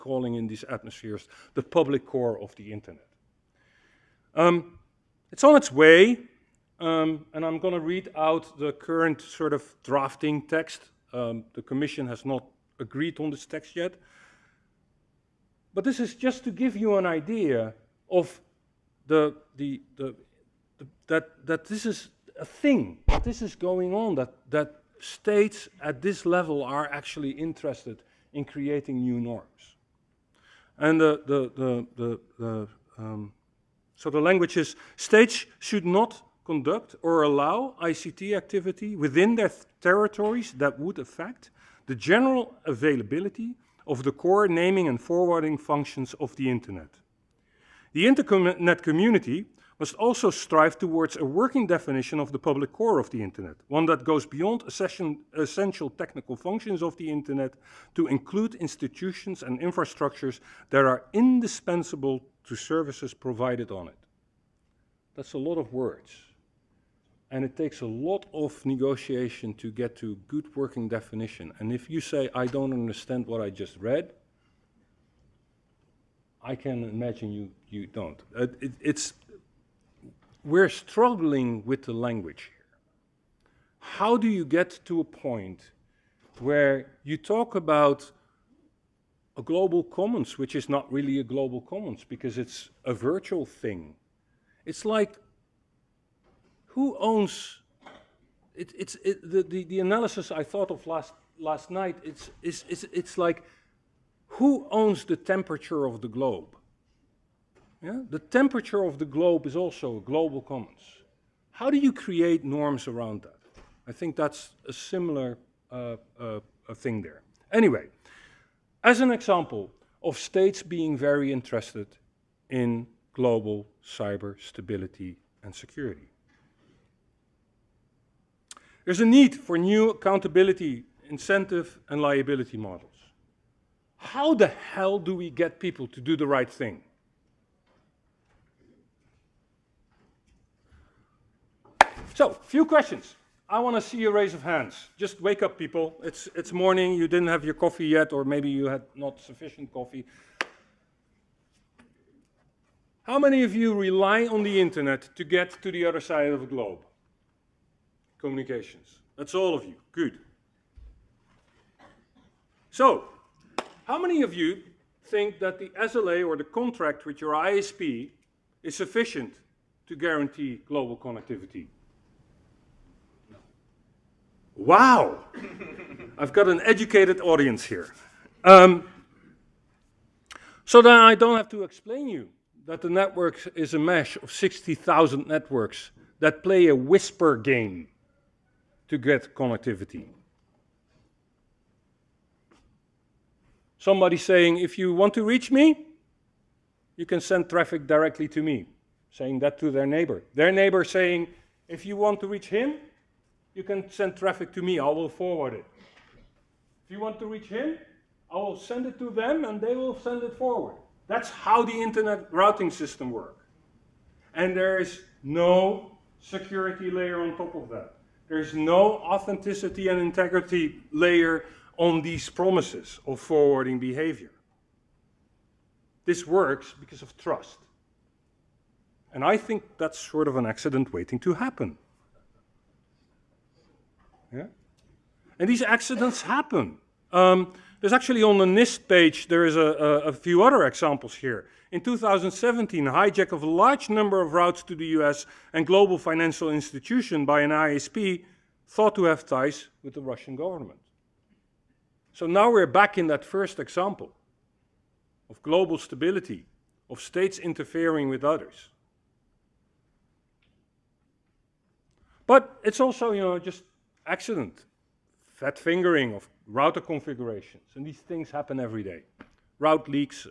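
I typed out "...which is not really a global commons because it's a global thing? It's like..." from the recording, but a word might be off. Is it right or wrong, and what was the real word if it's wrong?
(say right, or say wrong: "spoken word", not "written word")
wrong: "virtual", not "global".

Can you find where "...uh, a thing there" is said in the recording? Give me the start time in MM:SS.
01:56.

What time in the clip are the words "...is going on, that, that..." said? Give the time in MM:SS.
00:23.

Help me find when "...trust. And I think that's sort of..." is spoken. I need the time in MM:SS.
03:47.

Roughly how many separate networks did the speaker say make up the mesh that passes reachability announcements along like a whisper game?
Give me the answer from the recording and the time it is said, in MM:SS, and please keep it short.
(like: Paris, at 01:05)
60,000, at 03:04.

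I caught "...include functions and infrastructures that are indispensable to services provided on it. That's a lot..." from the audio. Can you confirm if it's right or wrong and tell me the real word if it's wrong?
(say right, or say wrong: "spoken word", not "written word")
wrong: "institutions", not "functions".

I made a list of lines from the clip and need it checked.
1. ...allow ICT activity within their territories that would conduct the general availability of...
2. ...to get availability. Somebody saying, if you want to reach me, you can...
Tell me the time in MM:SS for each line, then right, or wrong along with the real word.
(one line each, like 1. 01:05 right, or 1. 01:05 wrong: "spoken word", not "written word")
1. 00:37 wrong: "affect", not "conduct"
2. 03:08 wrong: "connectivity", not "availability".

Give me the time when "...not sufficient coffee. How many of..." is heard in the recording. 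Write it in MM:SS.
02:28.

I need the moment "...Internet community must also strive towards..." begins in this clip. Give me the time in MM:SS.
00:48.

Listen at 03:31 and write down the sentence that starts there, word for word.
That's how the internet routing system works.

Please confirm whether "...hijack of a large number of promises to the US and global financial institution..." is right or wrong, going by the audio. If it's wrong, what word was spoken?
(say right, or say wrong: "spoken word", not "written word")
wrong: "routes", not "promises".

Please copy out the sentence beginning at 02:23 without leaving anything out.
I want to see a raise of hands.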